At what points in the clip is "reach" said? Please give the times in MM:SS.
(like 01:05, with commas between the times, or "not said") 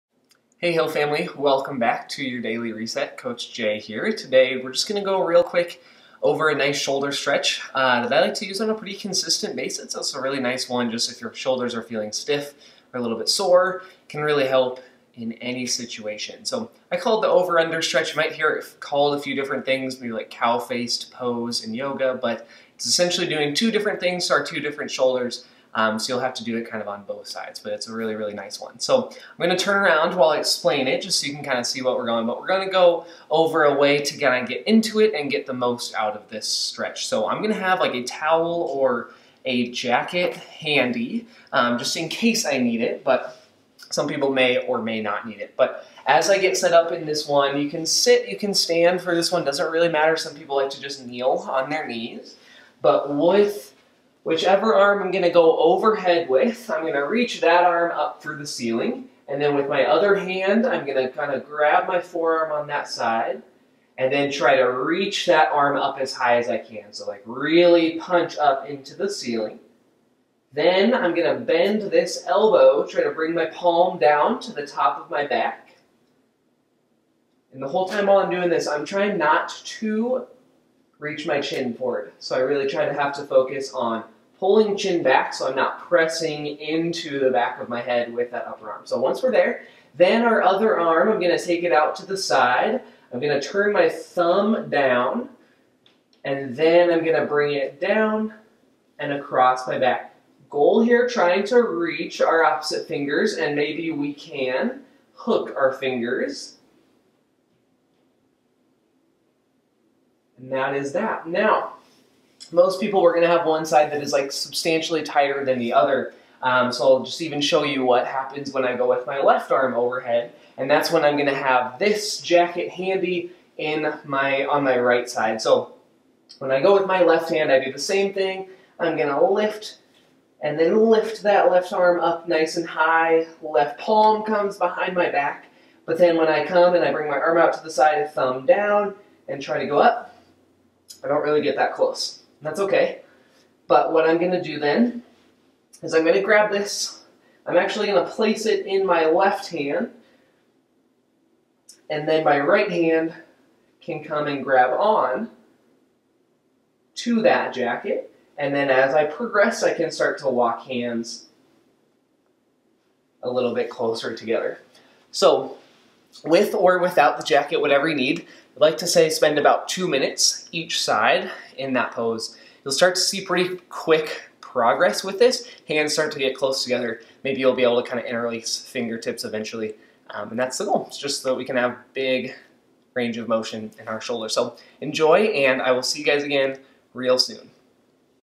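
00:57, 01:04, 01:21, 01:41.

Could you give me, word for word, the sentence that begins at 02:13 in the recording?
Left palm comes behind my back.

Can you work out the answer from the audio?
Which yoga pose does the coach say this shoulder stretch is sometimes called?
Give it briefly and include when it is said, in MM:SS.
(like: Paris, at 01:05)
cow-faced pose, at 00:20.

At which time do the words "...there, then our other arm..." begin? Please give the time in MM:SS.
01:29.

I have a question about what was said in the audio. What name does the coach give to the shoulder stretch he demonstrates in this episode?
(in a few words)
over-under stretch.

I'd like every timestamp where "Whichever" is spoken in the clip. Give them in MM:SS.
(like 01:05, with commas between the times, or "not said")
00:54.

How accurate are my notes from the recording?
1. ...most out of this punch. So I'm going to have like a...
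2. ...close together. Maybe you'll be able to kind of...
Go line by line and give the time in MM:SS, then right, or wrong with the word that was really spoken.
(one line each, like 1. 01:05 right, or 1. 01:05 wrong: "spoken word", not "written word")
1. 00:35 wrong: "stretch", not "punch"
2. 02:56 right.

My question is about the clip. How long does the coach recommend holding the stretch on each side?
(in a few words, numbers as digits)
2 minutes.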